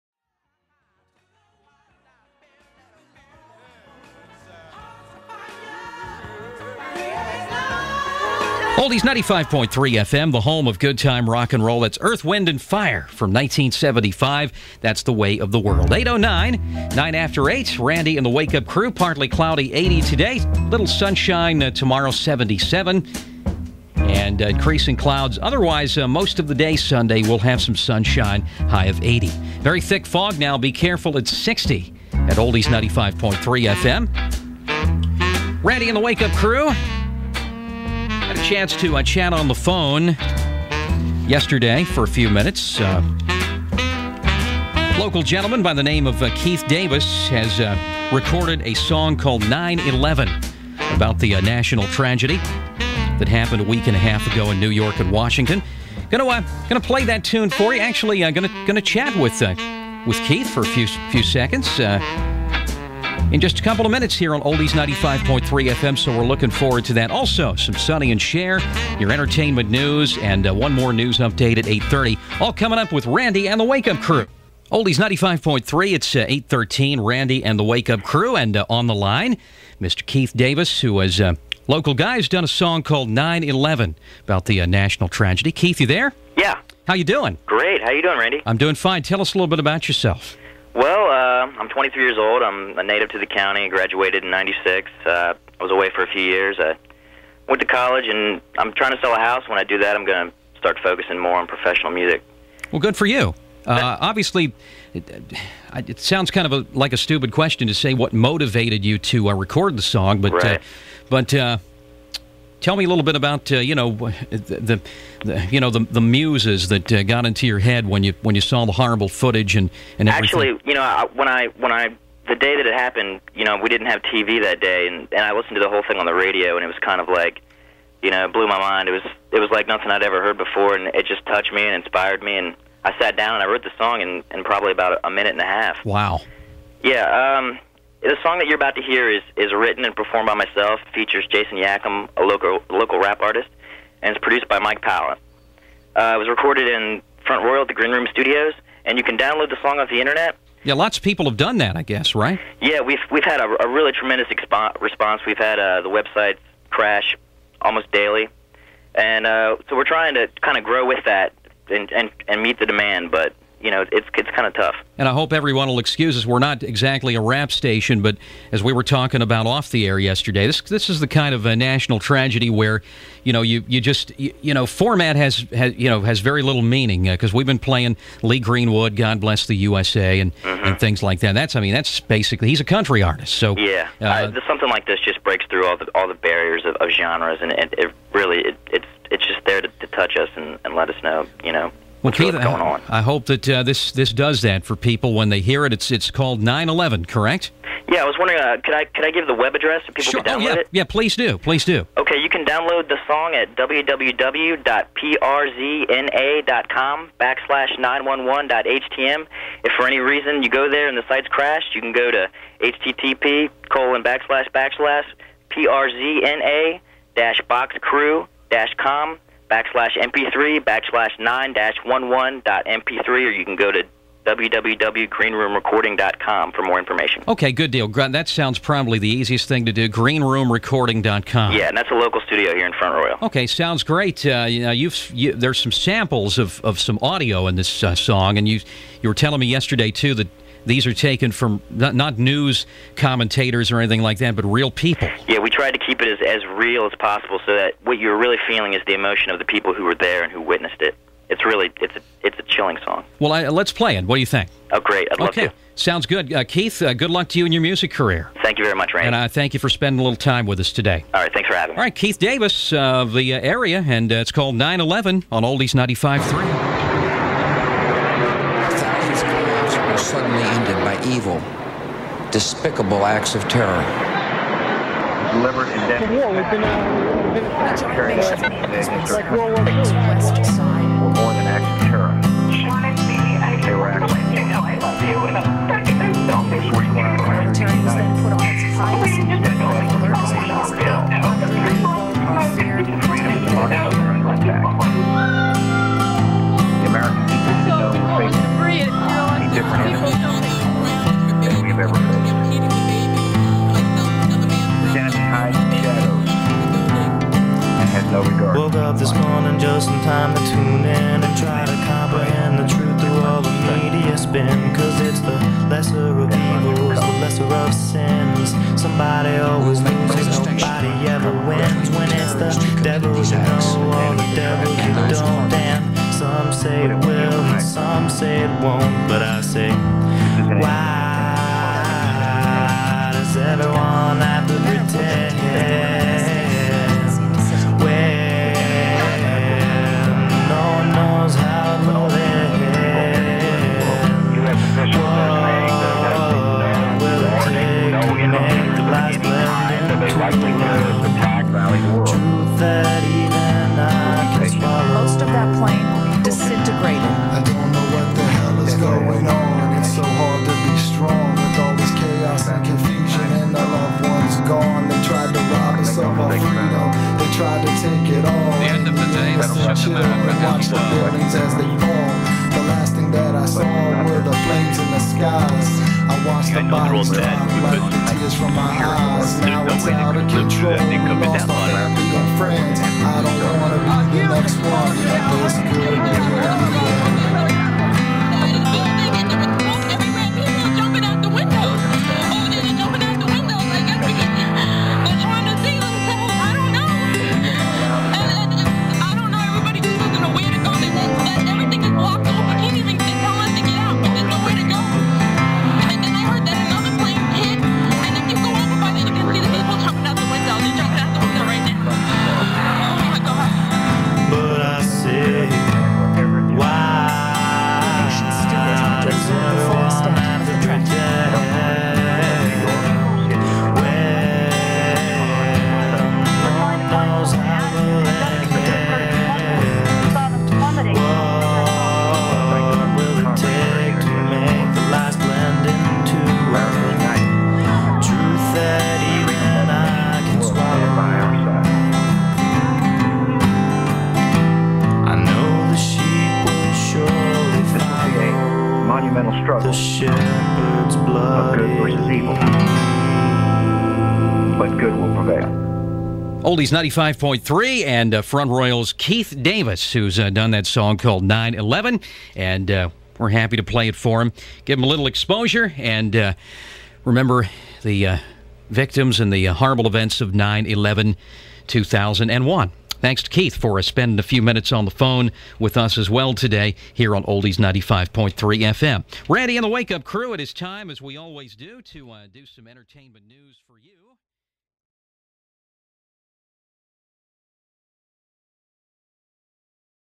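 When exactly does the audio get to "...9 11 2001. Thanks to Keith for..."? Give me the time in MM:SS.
07:50.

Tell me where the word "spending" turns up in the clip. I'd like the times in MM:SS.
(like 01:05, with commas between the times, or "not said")
04:19, 07:53.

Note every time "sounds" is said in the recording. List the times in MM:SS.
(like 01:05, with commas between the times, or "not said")
01:45, 03:48, 03:53, 04:15.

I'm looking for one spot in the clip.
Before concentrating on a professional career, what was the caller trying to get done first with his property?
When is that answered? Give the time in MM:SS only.
01:39.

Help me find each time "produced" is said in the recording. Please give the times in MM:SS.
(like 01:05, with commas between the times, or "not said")
02:24.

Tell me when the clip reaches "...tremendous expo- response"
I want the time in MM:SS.
02:33.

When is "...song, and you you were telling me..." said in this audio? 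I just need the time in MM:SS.
03:57.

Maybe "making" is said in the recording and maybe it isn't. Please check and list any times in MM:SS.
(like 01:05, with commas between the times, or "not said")
not said.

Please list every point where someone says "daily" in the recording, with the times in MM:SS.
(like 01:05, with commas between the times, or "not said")
02:37.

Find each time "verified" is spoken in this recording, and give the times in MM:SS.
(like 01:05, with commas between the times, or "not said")
not said.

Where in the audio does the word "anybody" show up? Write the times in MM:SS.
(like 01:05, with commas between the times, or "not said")
not said.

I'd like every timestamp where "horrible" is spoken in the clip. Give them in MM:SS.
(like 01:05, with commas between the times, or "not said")
01:58, 07:49.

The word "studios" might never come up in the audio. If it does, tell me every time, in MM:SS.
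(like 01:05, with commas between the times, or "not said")
02:28, 03:52.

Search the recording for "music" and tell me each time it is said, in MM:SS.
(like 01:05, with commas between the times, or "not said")
01:41, 04:17.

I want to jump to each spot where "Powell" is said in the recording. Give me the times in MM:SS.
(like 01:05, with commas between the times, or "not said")
02:24.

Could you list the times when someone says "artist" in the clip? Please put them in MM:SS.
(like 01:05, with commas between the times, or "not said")
02:23, 03:03.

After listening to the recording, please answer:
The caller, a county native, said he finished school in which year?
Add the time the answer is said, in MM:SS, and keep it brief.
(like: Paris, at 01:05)
1996, at 01:34.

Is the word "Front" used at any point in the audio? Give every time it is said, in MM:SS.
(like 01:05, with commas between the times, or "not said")
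02:27, 03:52, 07:38.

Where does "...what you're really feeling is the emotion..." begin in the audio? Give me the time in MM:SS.
04:07.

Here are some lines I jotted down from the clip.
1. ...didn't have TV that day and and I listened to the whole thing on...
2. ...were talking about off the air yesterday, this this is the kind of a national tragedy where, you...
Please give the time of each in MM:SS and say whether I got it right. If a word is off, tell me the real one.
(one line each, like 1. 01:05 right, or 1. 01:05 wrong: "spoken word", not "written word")
1. 02:03 right
2. 02:48 right.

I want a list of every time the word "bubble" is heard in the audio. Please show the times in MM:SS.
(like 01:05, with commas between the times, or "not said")
not said.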